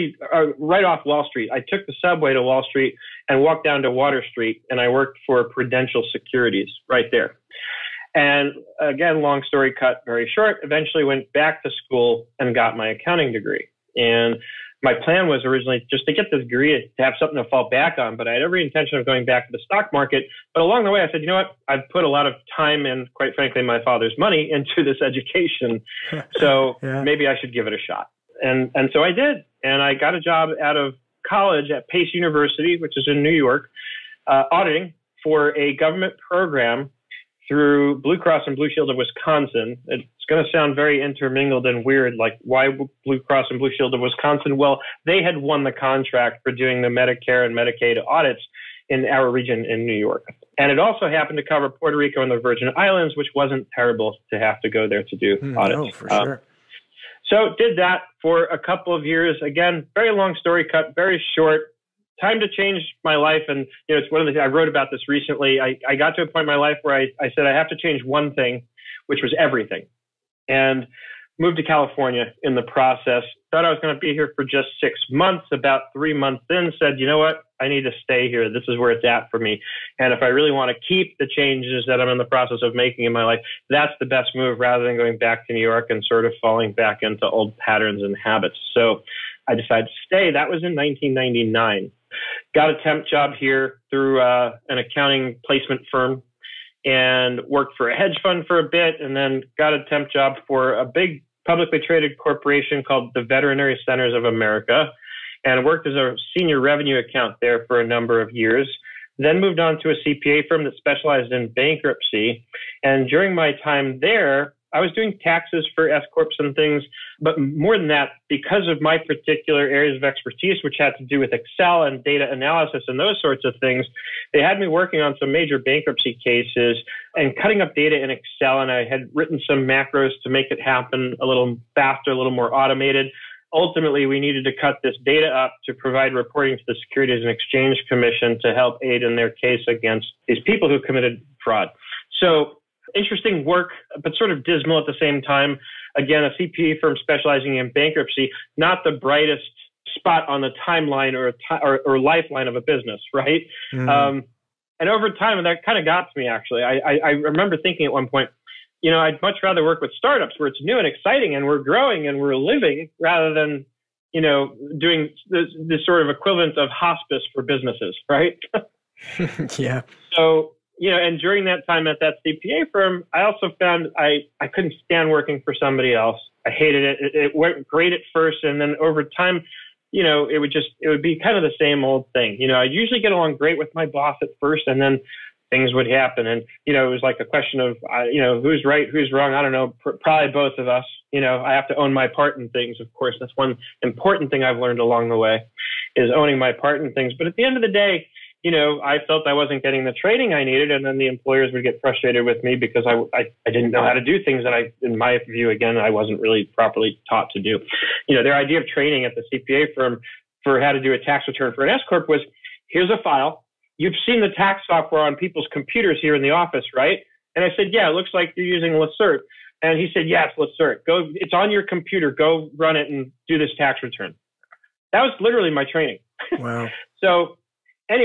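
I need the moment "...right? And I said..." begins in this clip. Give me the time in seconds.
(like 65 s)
216 s.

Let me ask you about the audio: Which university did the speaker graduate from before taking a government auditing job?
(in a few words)
Pace University.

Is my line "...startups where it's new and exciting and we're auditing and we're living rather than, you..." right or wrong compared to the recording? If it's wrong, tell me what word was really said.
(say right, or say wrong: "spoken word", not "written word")
wrong: "growing", not "auditing".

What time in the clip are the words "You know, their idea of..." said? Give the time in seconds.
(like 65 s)
208 s.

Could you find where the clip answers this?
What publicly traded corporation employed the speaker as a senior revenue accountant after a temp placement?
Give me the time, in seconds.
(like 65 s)
103 s.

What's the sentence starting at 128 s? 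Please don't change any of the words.
And I had written some macros to make it happen a little faster, a little more automated.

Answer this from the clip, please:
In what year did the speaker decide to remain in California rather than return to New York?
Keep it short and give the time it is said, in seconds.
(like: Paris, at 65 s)
1999, at 90 s.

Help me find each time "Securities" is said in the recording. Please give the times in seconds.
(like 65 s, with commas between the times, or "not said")
6 s, 136 s.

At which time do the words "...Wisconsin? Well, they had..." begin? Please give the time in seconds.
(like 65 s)
43 s.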